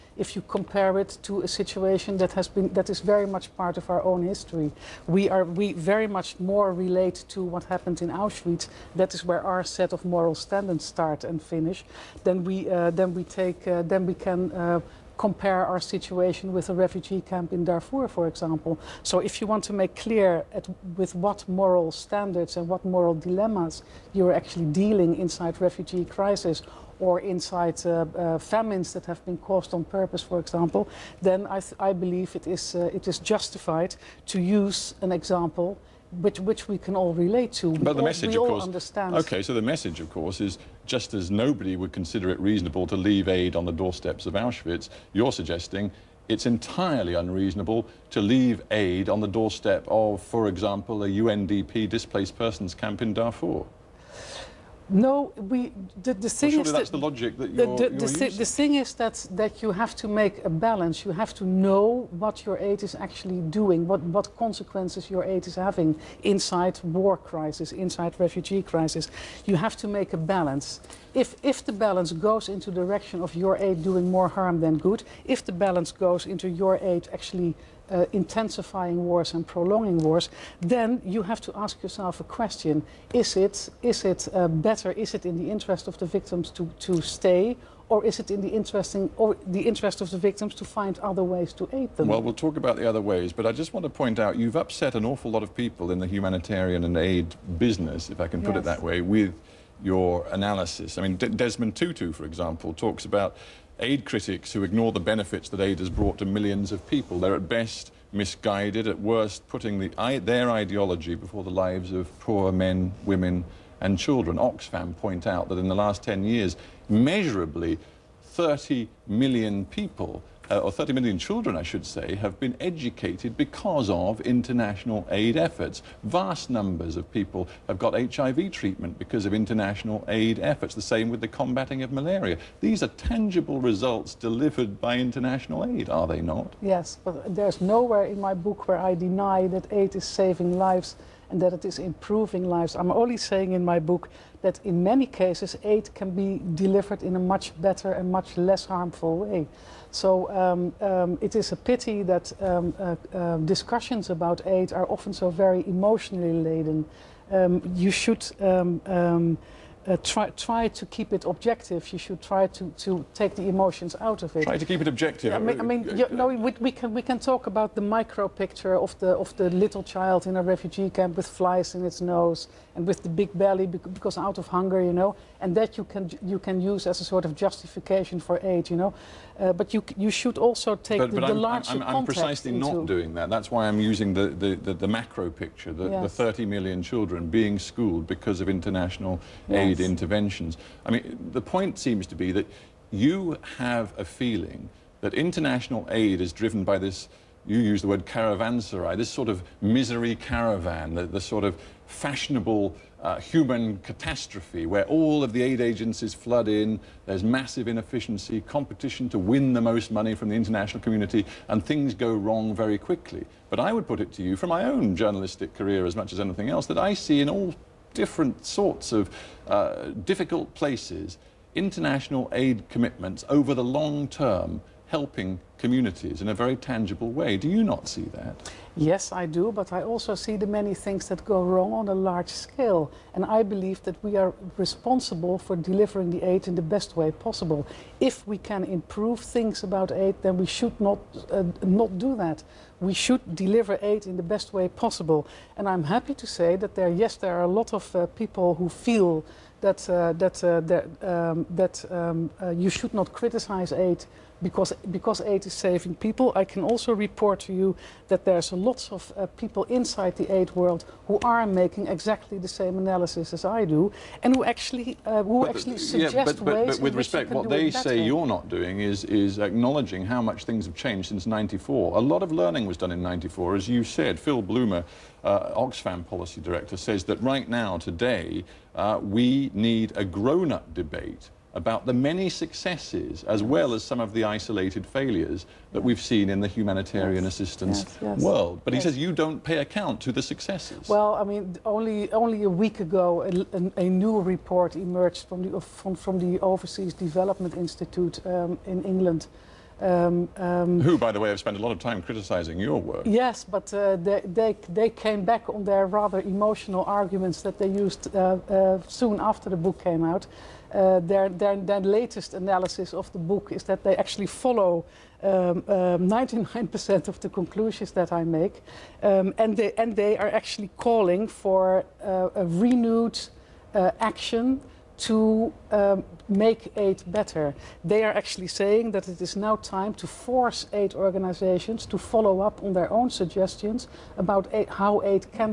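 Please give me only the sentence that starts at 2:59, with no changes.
Uh, but you you should also take but, the, but the I'm, larger I'm, I'm, I'm precisely into...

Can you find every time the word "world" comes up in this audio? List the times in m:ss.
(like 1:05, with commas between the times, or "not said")
4:20, 4:48.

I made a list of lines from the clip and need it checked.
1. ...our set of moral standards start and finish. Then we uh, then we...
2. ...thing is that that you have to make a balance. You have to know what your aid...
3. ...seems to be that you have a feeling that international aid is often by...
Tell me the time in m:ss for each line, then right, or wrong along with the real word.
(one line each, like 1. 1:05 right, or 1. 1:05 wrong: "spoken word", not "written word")
1. 0:09 right
2. 0:58 right
3. 3:11 wrong: "driven", not "often".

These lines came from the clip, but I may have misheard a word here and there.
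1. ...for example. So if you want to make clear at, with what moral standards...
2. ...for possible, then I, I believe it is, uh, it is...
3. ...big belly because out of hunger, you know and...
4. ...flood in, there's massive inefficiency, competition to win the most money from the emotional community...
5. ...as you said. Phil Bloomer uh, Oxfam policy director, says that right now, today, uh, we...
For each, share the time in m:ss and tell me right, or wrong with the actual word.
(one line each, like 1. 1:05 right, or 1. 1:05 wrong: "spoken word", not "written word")
1. 0:18 right
2. 0:30 wrong: "example", not "possible"
3. 2:53 right
4. 3:26 wrong: "international", not "emotional"
5. 4:33 right.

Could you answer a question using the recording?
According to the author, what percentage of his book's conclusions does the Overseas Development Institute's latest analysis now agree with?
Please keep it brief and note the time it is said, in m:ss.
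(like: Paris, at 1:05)
99%, at 5:15.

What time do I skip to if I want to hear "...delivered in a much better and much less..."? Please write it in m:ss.
2:26.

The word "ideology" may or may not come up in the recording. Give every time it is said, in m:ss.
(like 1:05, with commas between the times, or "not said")
1:50.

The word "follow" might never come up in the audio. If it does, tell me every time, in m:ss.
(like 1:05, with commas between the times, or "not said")
5:14, 5:31.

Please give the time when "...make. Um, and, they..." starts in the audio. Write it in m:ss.
5:18.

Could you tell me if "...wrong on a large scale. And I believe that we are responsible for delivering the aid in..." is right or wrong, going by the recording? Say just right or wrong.
right.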